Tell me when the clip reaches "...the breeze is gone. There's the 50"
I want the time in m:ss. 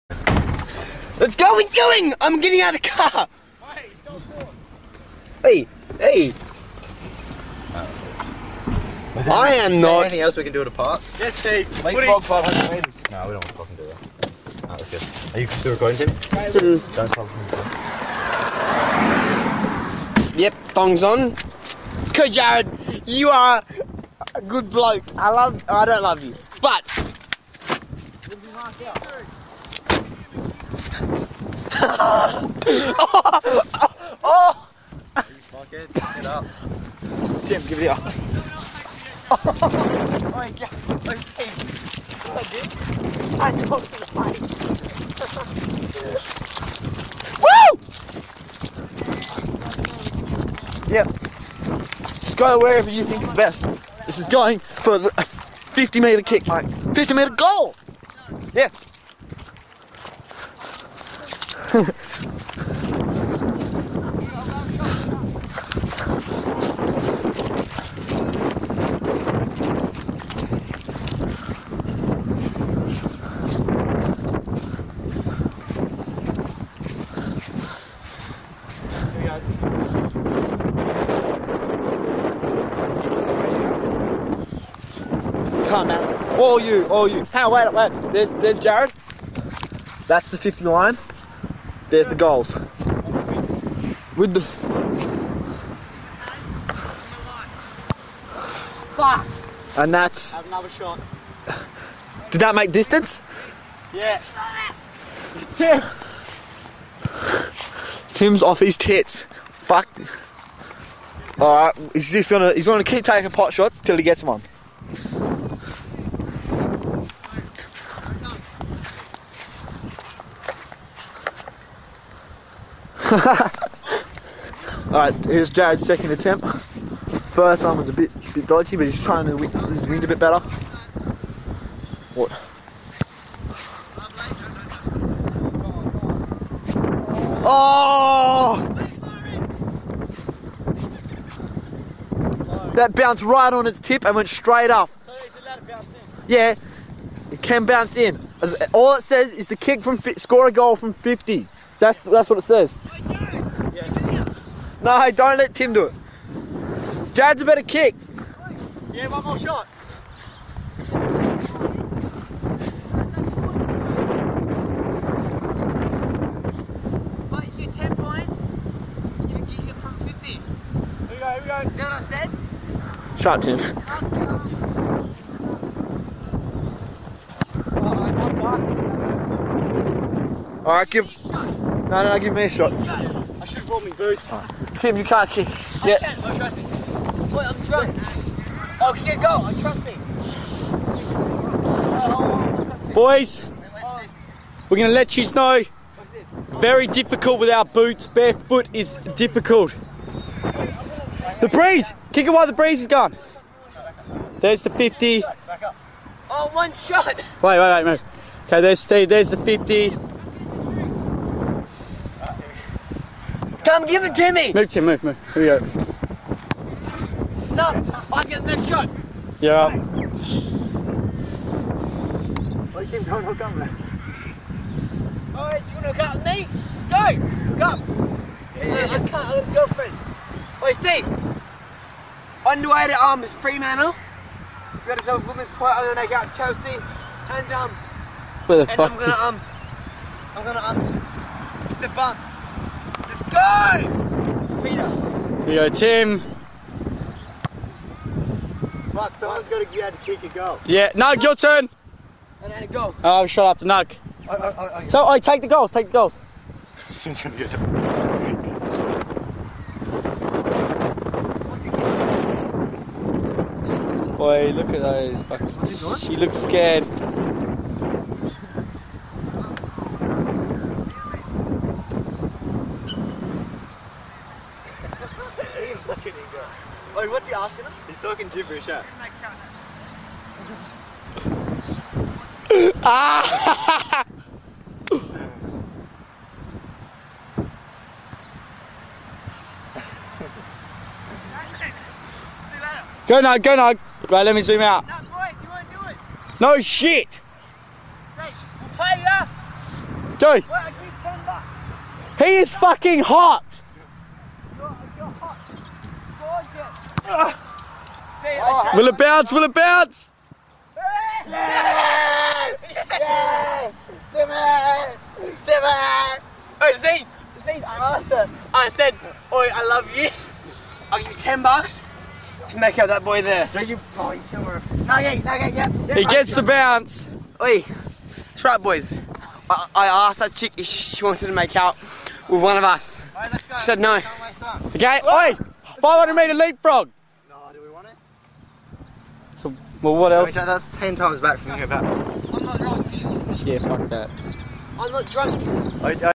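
3:22.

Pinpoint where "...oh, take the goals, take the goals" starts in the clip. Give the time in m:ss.
4:15.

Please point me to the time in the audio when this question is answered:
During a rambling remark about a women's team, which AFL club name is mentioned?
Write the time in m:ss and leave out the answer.
3:53.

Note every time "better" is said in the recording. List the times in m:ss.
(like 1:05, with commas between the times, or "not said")
2:10, 2:37.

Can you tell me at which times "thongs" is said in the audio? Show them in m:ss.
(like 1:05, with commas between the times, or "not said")
0:20.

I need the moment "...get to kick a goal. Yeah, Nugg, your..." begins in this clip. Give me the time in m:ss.
4:09.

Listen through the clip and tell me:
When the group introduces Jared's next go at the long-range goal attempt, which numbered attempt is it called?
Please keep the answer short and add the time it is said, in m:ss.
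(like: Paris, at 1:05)
second, at 2:05.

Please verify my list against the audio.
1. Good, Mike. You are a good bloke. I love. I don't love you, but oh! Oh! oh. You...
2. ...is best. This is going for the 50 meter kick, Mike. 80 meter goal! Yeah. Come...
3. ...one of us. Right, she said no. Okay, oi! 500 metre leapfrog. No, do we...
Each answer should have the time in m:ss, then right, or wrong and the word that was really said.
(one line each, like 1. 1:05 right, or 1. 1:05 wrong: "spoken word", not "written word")
1. 0:22 wrong: "Jared", not "Mike"
2. 0:53 wrong: "50", not "80"
3. 5:32 right.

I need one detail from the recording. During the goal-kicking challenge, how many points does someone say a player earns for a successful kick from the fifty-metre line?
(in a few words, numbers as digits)
10.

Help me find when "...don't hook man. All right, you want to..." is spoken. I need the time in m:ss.
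3:43.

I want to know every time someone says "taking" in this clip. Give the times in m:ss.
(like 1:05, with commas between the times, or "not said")
0:41, 1:53.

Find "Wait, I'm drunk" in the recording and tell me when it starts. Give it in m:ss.
3:07.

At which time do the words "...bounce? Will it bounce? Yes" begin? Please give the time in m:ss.
5:08.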